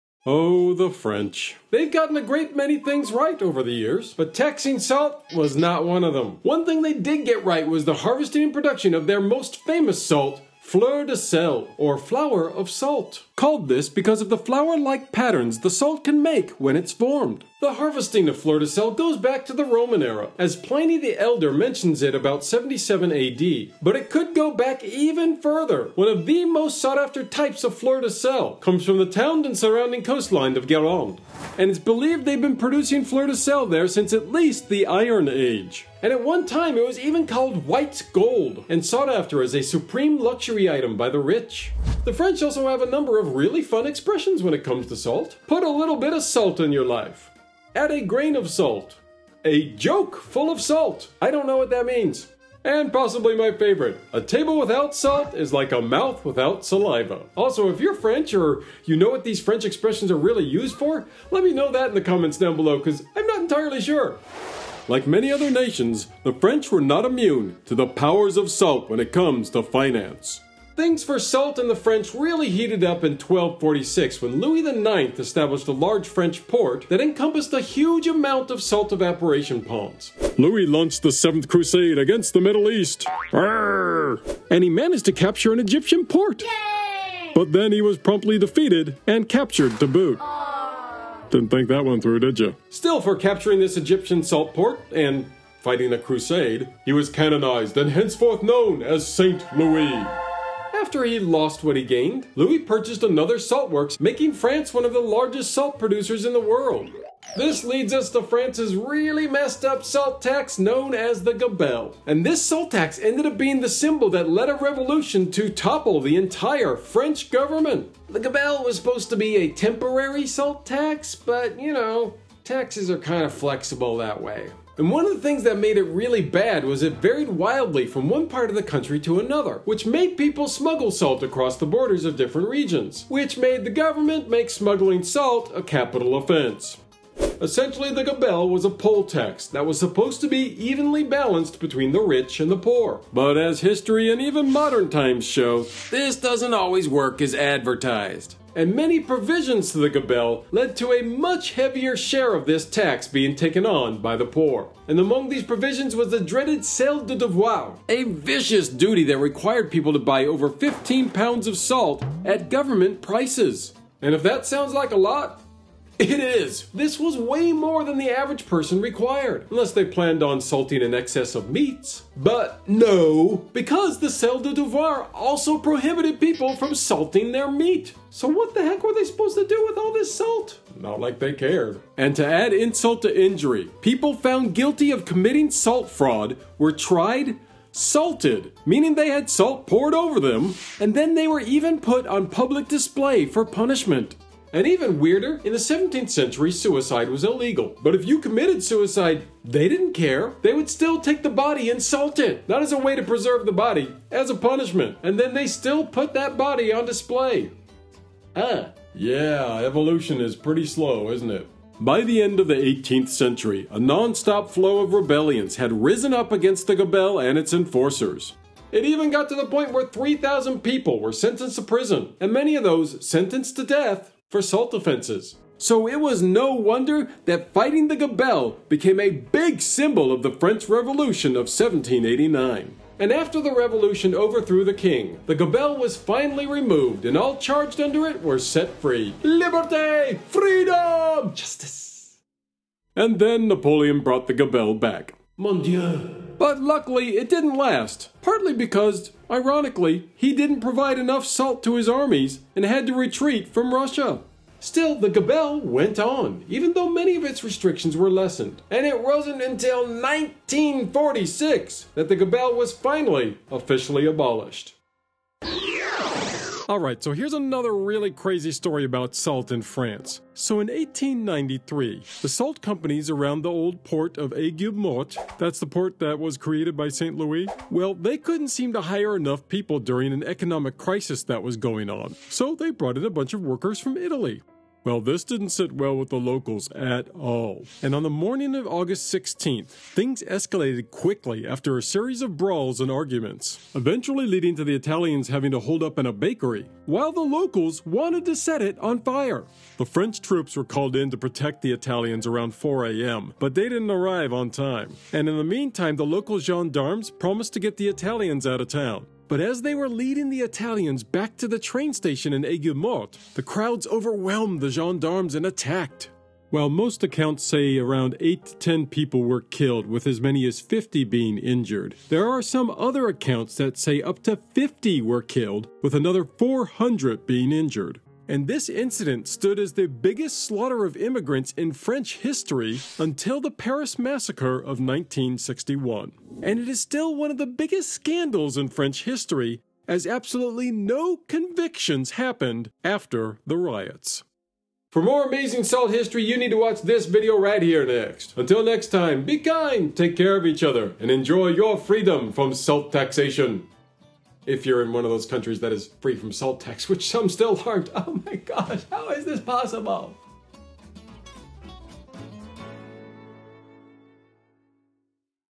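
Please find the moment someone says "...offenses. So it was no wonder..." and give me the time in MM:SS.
03:44.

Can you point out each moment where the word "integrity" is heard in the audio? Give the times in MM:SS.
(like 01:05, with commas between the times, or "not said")
not said.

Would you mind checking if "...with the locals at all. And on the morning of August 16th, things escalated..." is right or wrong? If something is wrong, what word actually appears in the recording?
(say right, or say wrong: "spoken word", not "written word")
right.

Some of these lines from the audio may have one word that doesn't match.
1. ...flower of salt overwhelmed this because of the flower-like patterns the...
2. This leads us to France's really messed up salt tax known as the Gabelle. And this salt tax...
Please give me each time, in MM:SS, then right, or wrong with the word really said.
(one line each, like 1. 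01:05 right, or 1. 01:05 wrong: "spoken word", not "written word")
1. 00:11 wrong: "called", not "overwhelmed"
2. 01:47 right.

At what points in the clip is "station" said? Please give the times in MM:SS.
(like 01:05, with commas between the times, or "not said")
05:11.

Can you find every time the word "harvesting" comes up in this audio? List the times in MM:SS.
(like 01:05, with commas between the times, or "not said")
00:07, 00:17.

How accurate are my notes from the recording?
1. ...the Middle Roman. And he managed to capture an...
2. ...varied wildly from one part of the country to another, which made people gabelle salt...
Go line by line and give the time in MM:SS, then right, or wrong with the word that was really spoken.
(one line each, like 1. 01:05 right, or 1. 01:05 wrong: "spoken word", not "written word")
1. 01:22 wrong: "East", not "Roman"
2. 02:07 wrong: "smuggle", not "gabelle".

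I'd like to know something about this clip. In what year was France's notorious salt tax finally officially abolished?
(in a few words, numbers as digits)
1946.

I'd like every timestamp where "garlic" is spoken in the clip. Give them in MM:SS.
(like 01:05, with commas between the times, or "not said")
not said.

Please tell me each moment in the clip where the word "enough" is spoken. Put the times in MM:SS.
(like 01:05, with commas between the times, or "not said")
04:10, 04:39.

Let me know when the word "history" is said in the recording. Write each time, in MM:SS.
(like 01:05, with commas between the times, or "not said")
02:23, 05:32, 05:39, 05:45.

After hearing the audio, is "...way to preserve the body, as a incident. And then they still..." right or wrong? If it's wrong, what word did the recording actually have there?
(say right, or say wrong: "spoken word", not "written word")
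wrong: "punishment", not "incident".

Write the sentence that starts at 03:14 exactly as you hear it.
And even weirder, in the 17th century, suicide was illegal.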